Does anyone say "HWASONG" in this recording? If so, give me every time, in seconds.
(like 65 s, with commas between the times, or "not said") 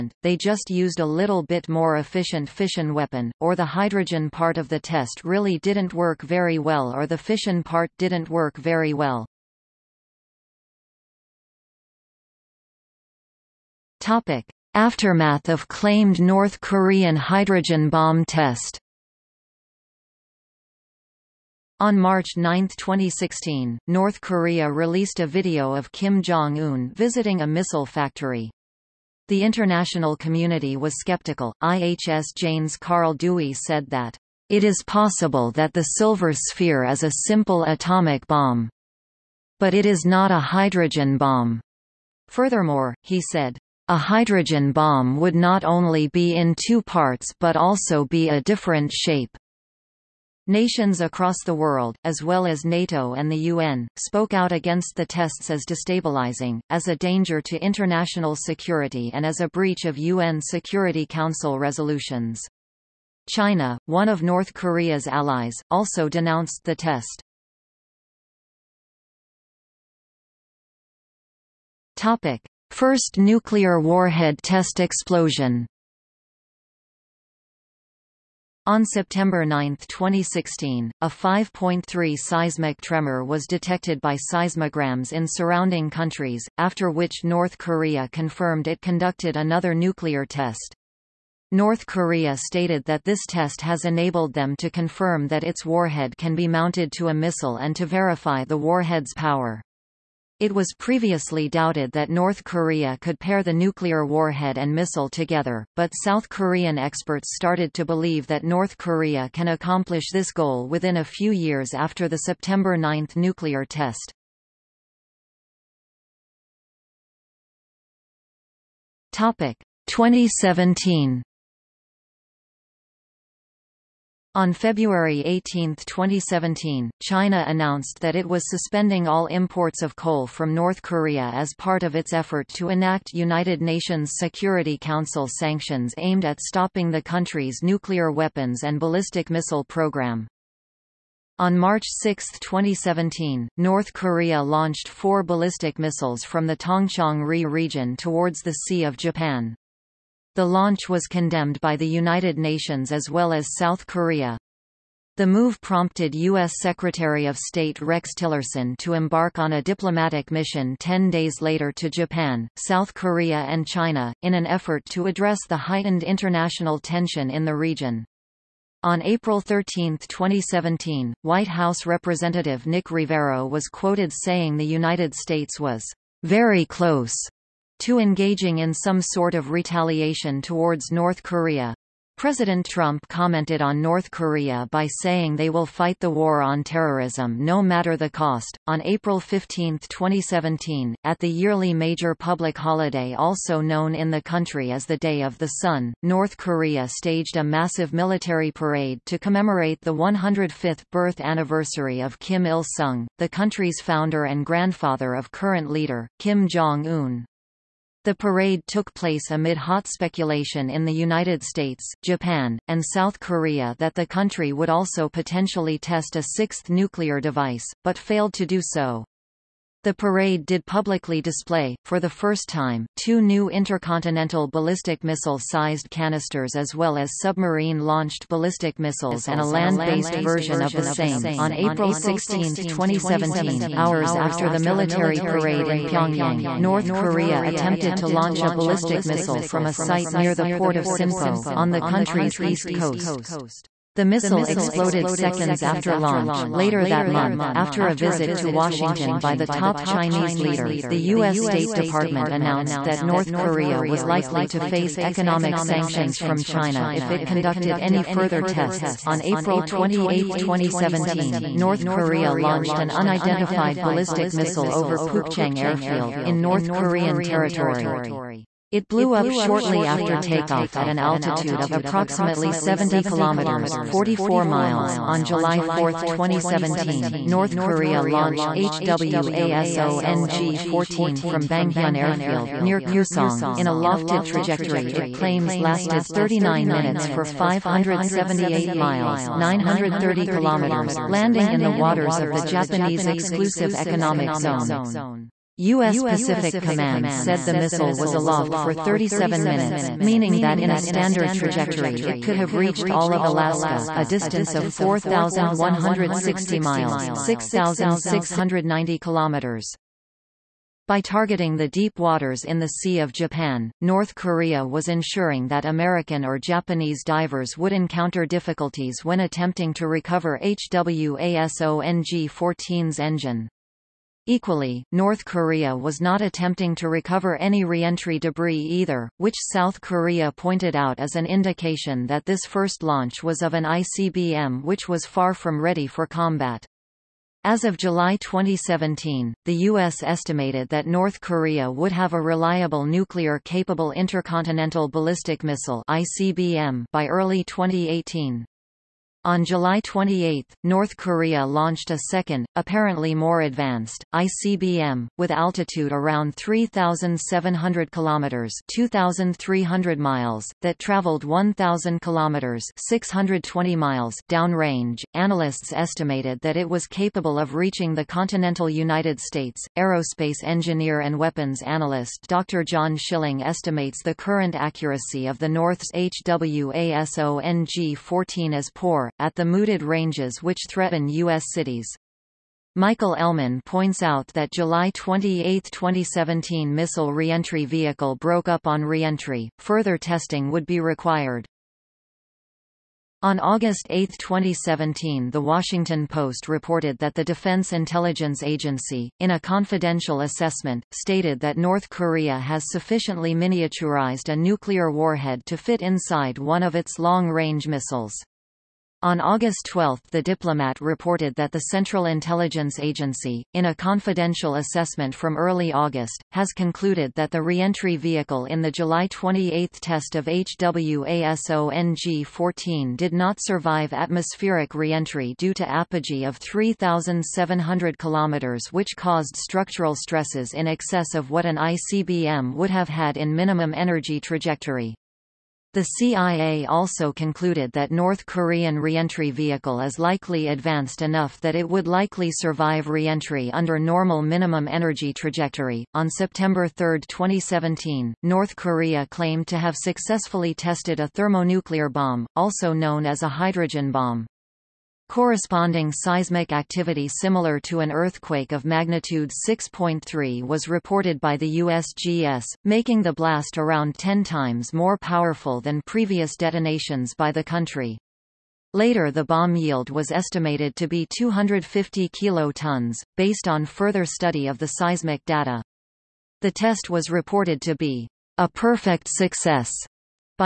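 278 s, 320 s, 375 s, 420 s.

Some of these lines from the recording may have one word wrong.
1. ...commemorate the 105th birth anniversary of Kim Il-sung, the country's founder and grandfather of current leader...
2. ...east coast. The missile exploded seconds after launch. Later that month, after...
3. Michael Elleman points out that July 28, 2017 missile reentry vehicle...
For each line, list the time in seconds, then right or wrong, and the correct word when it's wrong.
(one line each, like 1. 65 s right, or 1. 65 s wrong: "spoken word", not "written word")
1. 199 s right
2. 242 s right
3. 382 s right.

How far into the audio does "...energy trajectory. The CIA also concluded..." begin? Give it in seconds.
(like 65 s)
433 s.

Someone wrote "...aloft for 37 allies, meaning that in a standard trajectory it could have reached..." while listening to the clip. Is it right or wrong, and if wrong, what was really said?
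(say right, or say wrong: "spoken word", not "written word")
wrong: "minutes", not "allies".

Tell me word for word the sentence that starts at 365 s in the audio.
Analysts estimated that it was capable of reaching the continental United States.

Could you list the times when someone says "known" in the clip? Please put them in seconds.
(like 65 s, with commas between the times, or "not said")
193 s, 452 s.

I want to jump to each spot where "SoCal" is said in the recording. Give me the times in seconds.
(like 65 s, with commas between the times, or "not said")
not said.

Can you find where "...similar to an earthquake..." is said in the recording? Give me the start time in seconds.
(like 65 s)
457 s.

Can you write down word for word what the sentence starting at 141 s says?
On March 6, 2017, North Korea launched four ballistic missiles from the Tongchang-ri region towards the Sea of Japan.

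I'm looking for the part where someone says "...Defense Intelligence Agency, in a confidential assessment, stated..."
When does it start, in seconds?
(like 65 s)
397 s.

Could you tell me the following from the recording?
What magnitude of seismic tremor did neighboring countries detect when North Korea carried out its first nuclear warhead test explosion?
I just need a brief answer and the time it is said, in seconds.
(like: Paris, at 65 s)
5.3, at 81 s.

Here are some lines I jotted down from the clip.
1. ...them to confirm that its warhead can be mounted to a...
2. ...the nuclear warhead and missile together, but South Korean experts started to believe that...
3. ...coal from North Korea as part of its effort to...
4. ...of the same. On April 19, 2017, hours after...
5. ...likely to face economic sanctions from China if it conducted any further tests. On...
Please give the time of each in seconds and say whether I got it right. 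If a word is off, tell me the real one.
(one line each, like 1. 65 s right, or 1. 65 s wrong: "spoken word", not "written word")
1. 94 s right
2. 103 s right
3. 129 s right
4. 230 s wrong: "16", not "19"
5. 254 s right.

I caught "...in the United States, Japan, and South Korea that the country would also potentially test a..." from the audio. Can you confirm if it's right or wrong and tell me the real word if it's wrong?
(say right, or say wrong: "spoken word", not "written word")
right.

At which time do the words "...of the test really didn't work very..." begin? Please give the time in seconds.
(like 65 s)
4 s.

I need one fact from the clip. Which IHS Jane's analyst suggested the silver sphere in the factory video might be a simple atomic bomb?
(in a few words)
Carl Dewey.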